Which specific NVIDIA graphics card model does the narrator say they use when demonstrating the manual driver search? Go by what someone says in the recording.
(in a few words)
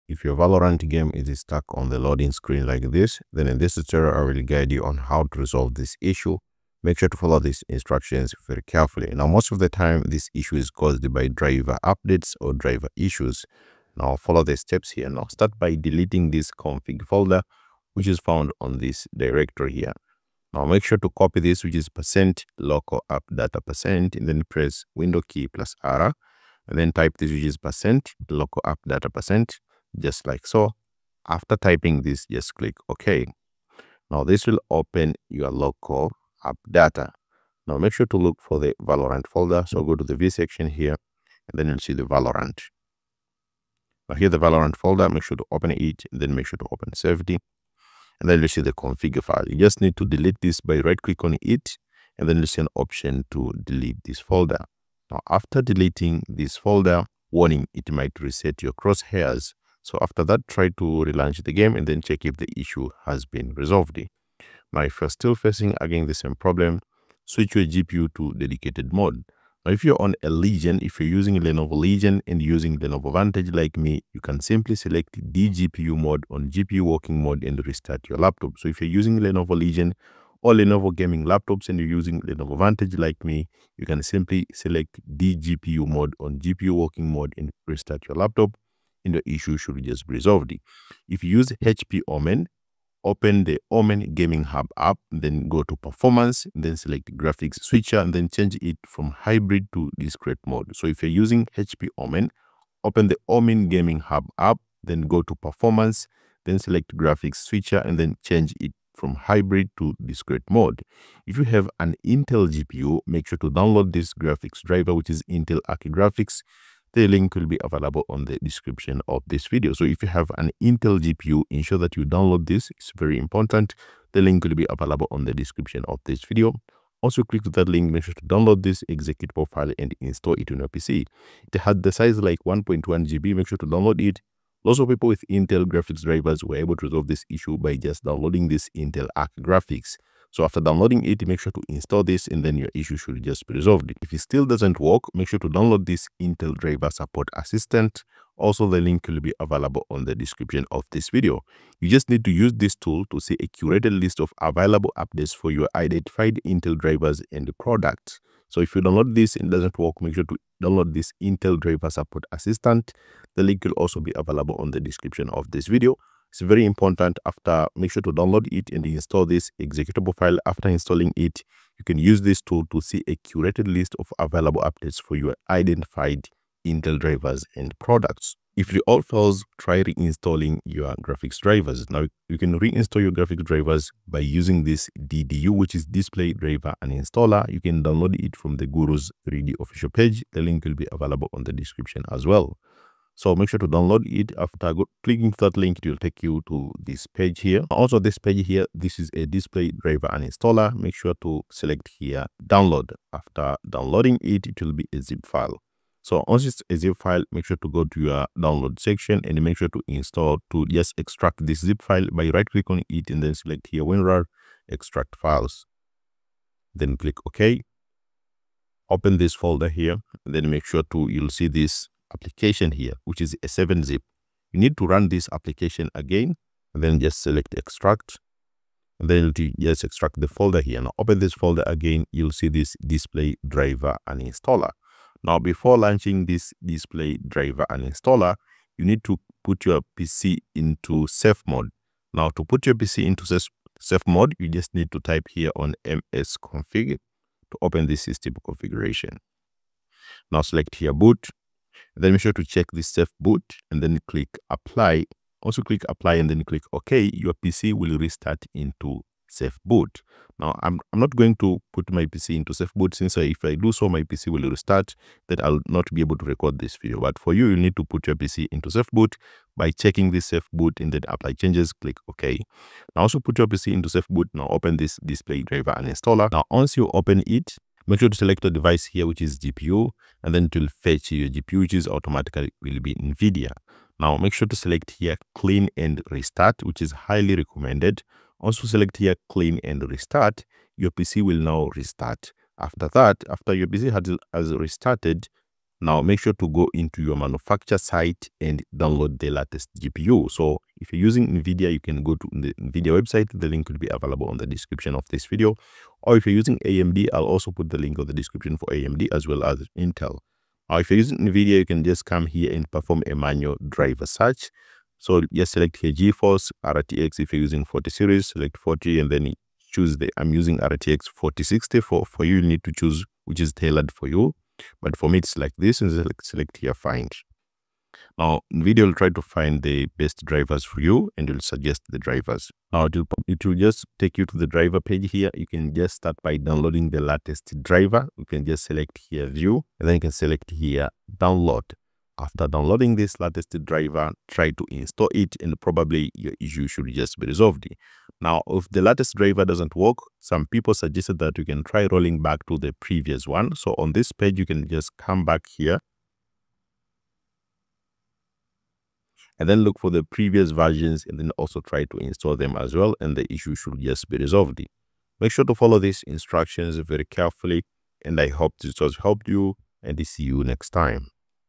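RTX 4060.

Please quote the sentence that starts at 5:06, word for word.
Or if you're using AMD, I'll also put the link on the description for AMD as well as Intel.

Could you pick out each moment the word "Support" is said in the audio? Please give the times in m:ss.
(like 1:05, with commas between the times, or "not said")
2:26, 2:41.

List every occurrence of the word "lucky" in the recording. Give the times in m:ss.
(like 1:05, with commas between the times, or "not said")
not said.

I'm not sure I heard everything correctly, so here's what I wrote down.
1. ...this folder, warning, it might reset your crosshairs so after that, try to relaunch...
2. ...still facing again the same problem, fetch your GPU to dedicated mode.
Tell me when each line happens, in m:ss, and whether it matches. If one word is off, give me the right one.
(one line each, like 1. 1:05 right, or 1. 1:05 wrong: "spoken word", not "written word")
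1. 0:56 right
2. 1:05 wrong: "switch", not "fetch".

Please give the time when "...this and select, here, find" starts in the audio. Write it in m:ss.
5:25.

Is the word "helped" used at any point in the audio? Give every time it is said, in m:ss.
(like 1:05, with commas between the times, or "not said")
6:09.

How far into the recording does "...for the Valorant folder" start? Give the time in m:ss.
0:38.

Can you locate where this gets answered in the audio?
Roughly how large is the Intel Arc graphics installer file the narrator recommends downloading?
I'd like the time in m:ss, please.
2:12.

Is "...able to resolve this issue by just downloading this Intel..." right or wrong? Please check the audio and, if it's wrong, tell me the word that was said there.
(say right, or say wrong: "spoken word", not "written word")
right.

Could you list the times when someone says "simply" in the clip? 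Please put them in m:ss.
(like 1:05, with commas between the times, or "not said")
1:14, 1:24.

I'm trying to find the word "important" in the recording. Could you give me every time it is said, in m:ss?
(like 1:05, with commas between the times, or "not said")
2:03, 2:46.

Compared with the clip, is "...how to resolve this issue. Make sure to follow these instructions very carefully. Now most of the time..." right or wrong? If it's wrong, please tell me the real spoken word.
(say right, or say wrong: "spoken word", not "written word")
right.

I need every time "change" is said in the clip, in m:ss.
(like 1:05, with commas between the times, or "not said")
1:38, 1:48, 4:31.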